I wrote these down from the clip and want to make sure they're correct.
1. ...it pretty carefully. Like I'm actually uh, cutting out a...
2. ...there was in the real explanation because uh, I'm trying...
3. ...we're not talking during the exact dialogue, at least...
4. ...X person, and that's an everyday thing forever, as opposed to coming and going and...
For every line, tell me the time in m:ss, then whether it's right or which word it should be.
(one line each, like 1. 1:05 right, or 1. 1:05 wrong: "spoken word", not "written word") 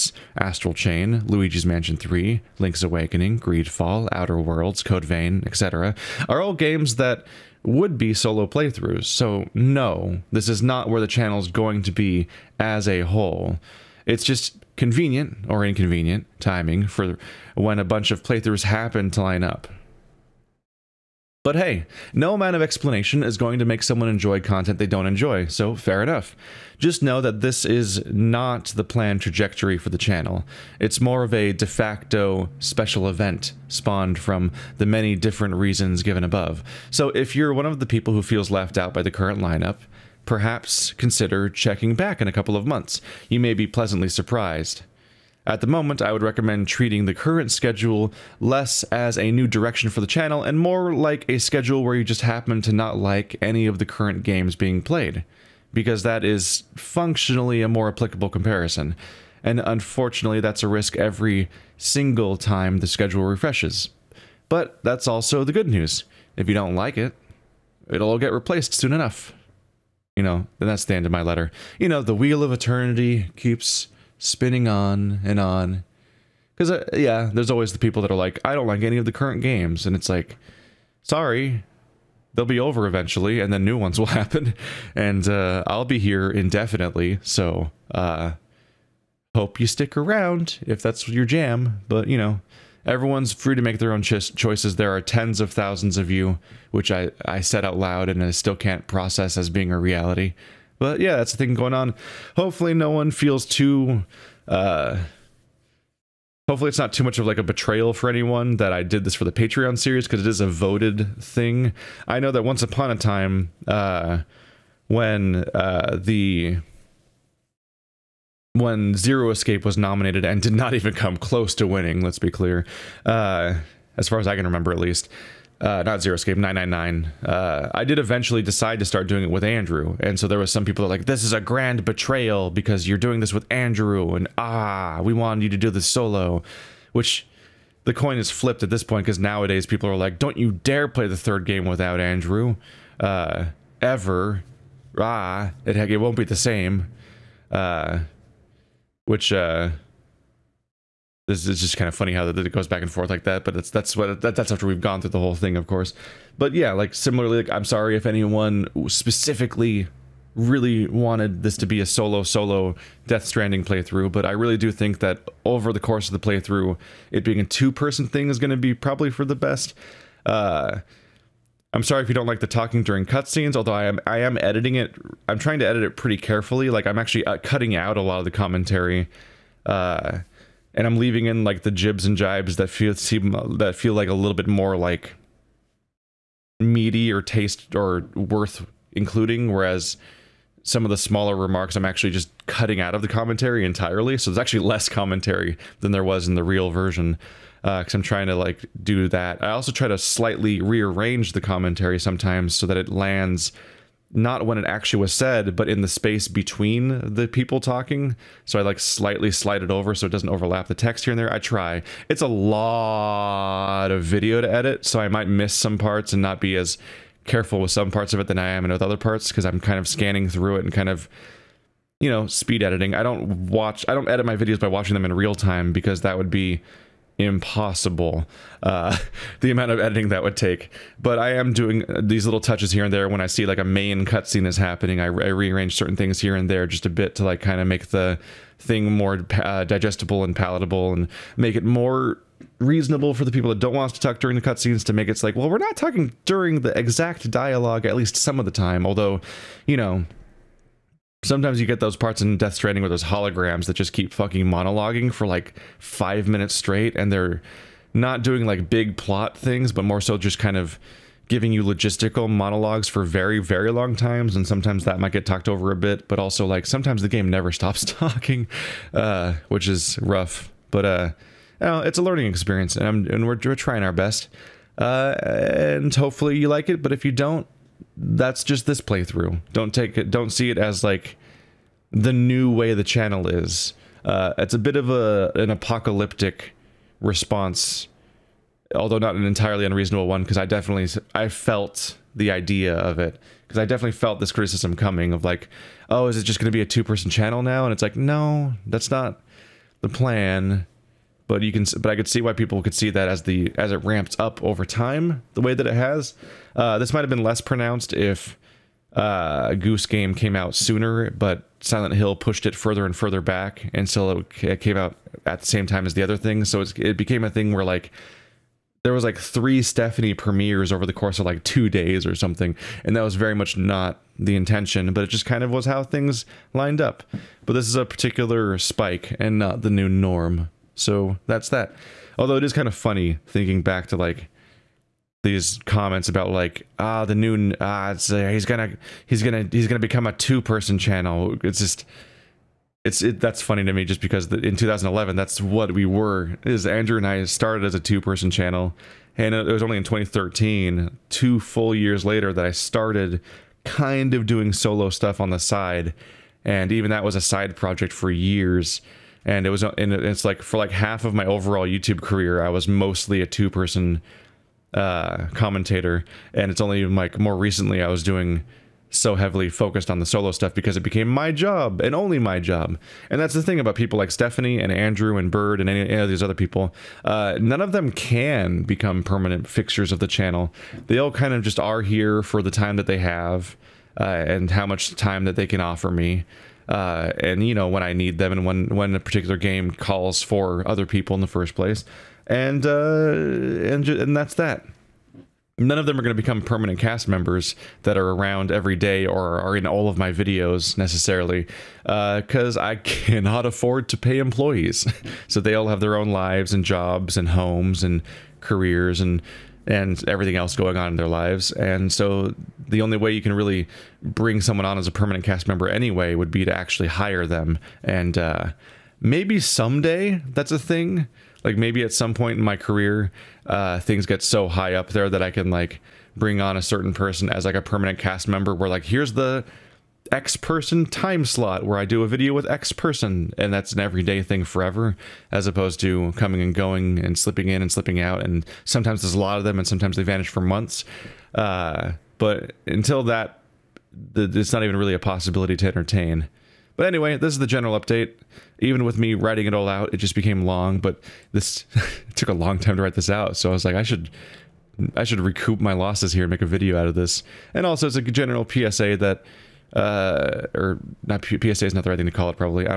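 1. 2:55 right
2. 3:15 wrong: "version", not "explanation"
3. 4:05 right
4. 7:12 right.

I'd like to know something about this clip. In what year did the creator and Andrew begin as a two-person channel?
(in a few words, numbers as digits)
2011.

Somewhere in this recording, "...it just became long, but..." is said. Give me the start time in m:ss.
7:29.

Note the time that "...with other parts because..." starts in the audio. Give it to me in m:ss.
3:38.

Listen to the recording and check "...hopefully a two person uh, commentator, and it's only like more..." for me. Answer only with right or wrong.
wrong.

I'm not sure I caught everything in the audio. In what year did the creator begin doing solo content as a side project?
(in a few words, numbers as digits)
2013.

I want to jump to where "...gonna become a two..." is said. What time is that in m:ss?
5:39.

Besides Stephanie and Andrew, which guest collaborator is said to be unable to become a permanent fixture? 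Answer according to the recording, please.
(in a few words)
Bird.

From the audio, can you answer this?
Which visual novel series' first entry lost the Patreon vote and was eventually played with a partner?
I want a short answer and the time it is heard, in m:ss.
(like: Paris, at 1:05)
999, at 2:06.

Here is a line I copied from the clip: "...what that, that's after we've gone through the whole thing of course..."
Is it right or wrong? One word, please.
right.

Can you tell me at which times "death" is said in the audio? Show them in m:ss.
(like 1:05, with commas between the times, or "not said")
2:43, 4:12.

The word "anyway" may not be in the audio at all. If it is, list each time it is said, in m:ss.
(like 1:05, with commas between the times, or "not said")
6:55, 7:26.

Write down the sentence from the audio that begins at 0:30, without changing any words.
It's more of a de facto special event spawned from the many different reasons given above.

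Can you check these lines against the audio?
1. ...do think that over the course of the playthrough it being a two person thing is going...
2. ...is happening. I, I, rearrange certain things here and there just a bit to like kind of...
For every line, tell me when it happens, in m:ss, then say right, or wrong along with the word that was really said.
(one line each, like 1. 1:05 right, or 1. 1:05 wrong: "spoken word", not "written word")
1. 2:44 right
2. 3:54 right.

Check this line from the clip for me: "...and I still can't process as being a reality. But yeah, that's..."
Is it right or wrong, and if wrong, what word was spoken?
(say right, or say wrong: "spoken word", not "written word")
right.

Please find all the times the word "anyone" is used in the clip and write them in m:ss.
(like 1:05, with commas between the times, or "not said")
1:48, 2:38.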